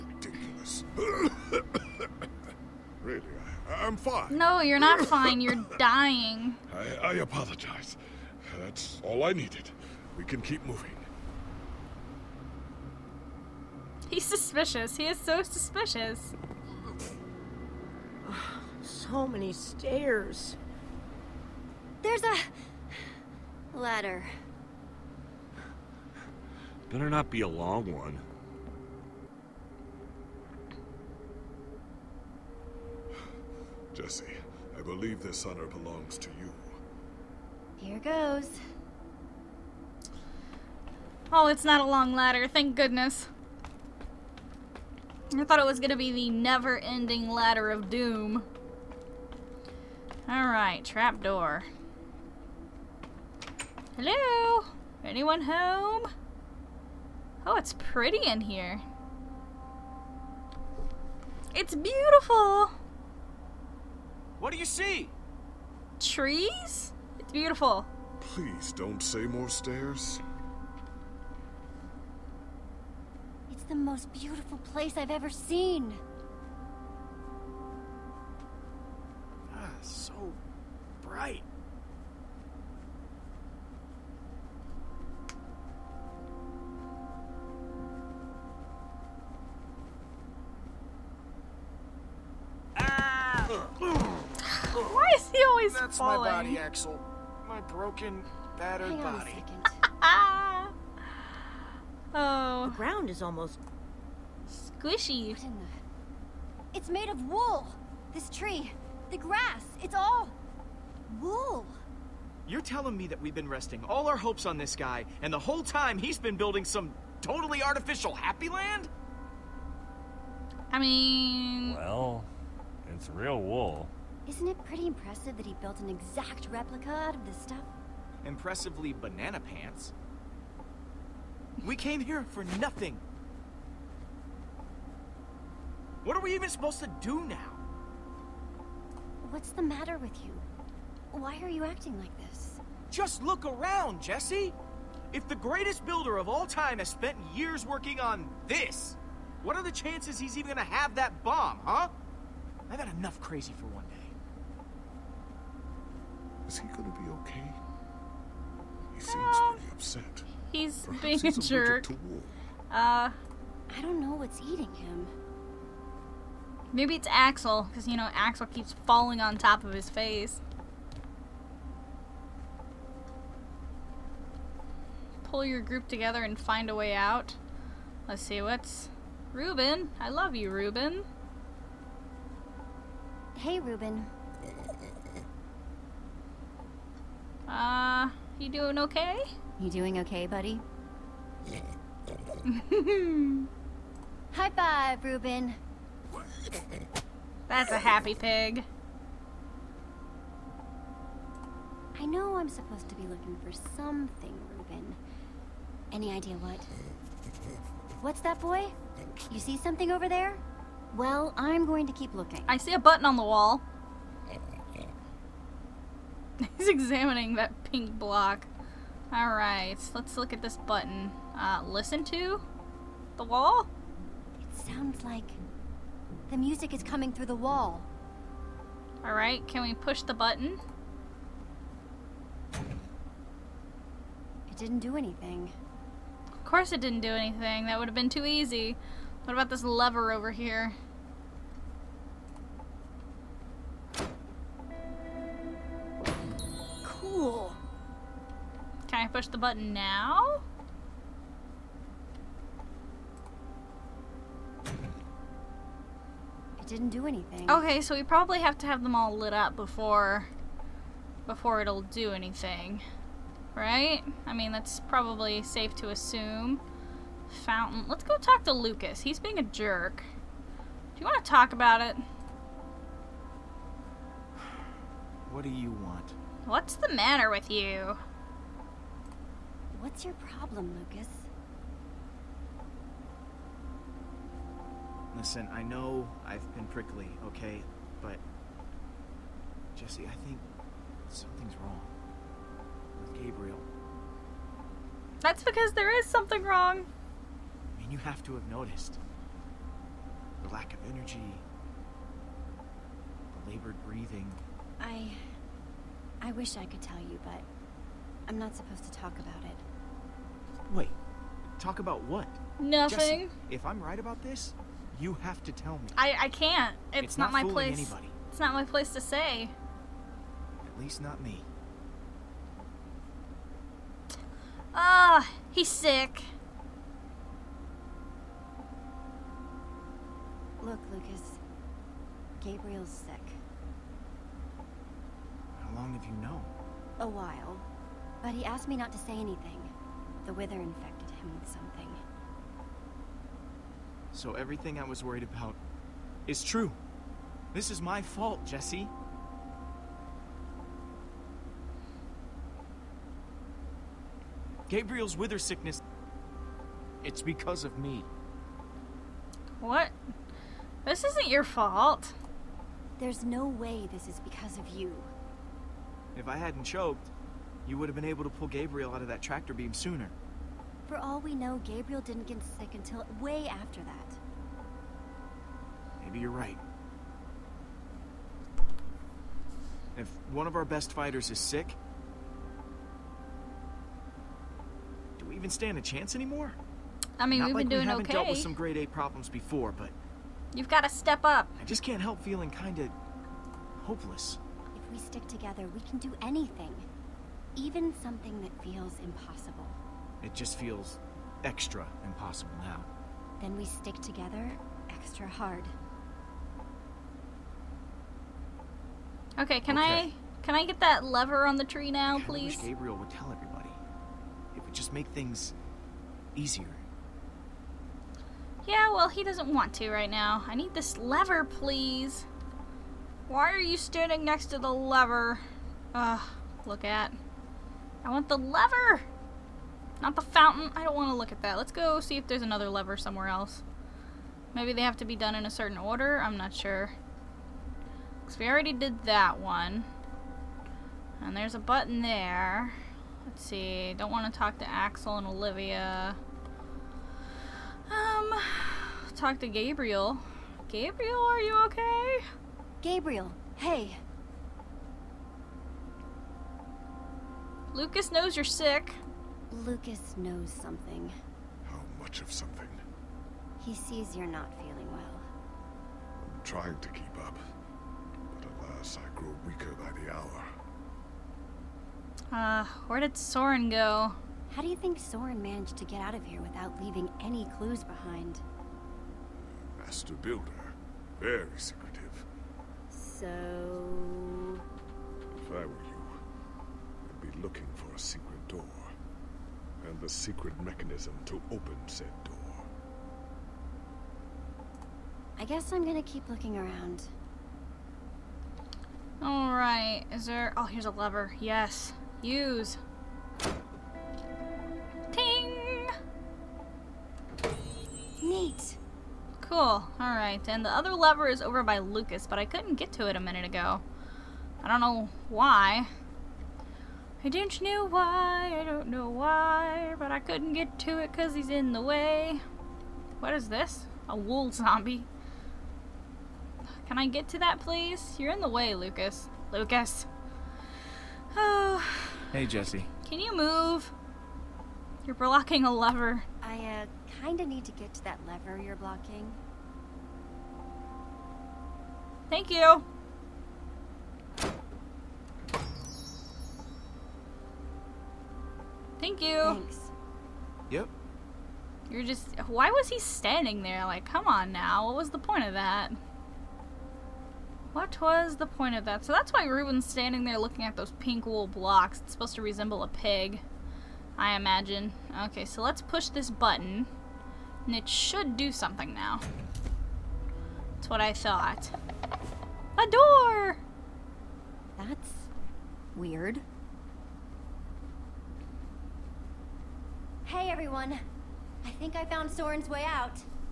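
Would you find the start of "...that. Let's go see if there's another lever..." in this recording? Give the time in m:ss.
7:11.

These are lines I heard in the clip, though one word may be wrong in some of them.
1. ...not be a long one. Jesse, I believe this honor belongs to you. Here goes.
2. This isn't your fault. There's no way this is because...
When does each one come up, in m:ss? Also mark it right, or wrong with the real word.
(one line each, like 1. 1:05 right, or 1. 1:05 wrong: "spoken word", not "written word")
1. 0:27 right
2. 6:00 right.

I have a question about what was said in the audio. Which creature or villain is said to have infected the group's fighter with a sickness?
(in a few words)
The Wither.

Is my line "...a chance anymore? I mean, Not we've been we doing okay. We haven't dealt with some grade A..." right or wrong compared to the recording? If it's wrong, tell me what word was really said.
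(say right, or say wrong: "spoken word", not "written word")
right.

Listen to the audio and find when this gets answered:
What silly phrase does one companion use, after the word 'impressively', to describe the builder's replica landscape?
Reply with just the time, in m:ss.
2:08.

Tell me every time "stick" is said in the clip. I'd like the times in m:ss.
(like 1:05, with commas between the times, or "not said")
6:34, 6:43.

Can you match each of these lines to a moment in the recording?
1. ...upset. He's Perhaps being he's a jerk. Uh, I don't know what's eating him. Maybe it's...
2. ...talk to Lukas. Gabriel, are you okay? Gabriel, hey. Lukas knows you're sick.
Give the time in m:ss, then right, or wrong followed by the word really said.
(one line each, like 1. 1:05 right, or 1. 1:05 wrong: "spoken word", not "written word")
1. 2:39 right
2. 7:29 wrong: "Gabriel", not "Lukas".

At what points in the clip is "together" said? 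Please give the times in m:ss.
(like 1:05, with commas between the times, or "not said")
2:55, 6:35, 6:44.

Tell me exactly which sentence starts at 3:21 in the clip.
I know I'm supposed to be looking for something, Reuben.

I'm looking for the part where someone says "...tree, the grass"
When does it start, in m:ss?
1:48.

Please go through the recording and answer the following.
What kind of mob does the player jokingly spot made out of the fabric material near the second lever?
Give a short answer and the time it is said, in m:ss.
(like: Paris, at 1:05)
A wool zombie, at 8:44.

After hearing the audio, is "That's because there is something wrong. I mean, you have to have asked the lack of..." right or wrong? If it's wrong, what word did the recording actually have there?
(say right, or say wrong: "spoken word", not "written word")
wrong: "noticed", not "asked".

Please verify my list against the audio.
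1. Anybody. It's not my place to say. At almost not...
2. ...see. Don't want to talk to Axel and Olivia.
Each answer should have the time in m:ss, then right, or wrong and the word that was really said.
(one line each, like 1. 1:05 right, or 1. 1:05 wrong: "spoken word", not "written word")
1. 5:17 wrong: "least", not "almost"
2. 7:23 right.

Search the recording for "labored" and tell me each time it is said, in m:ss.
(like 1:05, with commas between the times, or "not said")
5:03.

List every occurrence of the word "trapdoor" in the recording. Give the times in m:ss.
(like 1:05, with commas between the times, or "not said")
0:50.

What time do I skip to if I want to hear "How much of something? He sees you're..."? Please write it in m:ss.
7:41.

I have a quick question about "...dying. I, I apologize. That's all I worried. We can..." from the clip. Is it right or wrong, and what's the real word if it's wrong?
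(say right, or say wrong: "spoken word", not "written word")
wrong: "needed", not "worried".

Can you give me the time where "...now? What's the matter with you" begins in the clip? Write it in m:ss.
2:17.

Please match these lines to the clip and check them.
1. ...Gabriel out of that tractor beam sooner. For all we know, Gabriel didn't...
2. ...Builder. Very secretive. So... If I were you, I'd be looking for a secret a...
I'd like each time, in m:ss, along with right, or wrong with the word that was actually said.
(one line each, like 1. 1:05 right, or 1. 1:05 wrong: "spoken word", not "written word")
1. 6:08 right
2. 8:00 right.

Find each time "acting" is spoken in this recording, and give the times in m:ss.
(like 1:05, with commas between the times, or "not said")
2:21.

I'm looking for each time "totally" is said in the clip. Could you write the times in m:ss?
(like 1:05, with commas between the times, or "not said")
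1:57.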